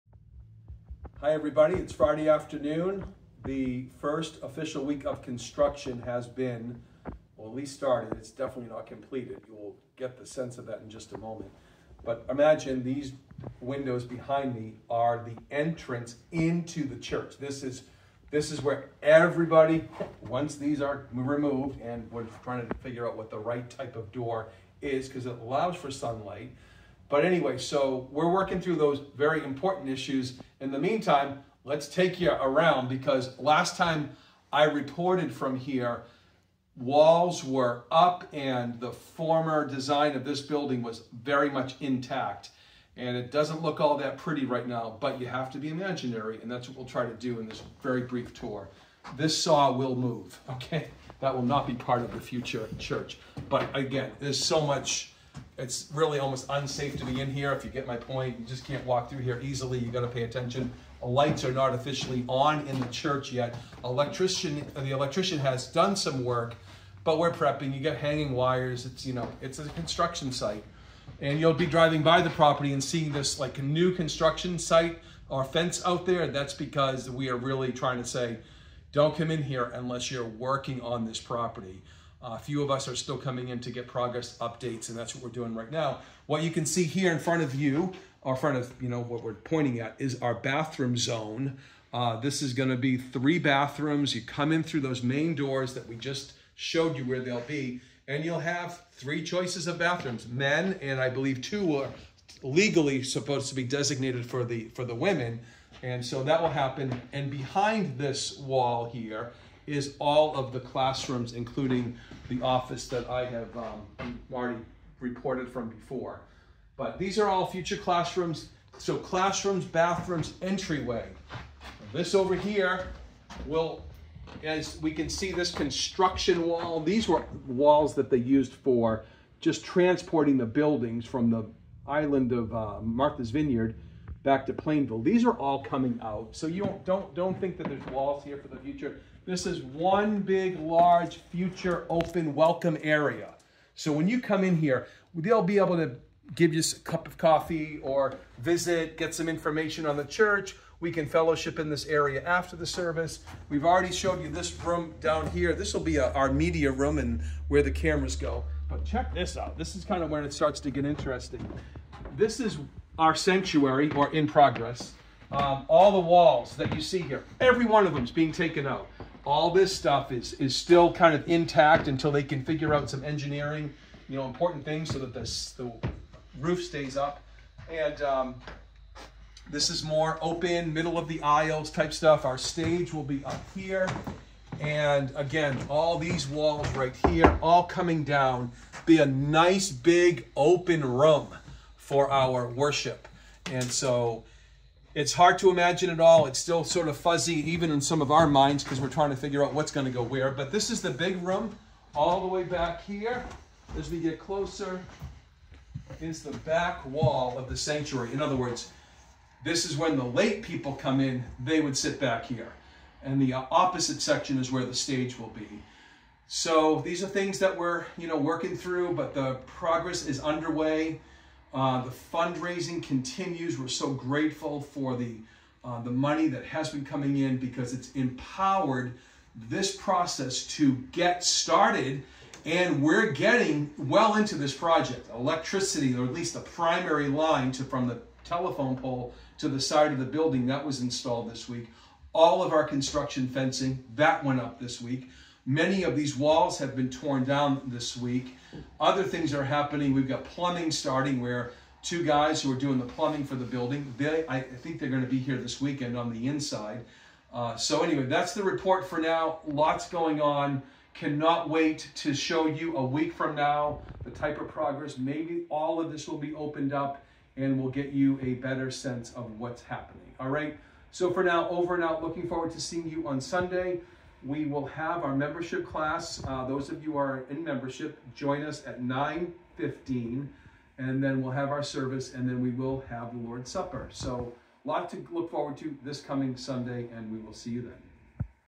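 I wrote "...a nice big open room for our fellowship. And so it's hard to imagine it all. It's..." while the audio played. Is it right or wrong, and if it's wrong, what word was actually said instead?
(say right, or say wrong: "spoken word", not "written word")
wrong: "worship", not "fellowship".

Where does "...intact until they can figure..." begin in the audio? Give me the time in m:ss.
2:51.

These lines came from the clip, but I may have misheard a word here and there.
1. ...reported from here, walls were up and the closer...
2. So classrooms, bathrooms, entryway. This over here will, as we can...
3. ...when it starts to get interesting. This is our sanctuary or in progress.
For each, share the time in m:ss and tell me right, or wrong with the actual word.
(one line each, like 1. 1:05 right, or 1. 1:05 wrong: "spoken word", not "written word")
1. 0:34 wrong: "former", not "closer"
2. 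1:58 right
3. 2:40 right.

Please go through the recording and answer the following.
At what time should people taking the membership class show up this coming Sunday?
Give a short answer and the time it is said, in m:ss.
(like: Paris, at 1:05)
9:15, at 4:38.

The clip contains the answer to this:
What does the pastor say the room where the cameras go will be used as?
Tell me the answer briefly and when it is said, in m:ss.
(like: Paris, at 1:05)
Media room, at 2:36.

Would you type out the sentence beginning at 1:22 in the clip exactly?
Uh, a few of us are still coming in to get progress updates, and that's what we're doing right now.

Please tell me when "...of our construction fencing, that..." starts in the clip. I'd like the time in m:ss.
4:02.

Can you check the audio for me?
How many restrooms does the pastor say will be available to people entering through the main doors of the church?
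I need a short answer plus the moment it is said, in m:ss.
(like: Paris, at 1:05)
3, at 1:32.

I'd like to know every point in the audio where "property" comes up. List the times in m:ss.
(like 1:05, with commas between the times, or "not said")
1:12, 1:21.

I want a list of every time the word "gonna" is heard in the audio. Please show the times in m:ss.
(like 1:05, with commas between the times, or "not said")
1:32.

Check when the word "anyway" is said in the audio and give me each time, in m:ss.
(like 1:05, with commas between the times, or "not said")
0:27, 4:17.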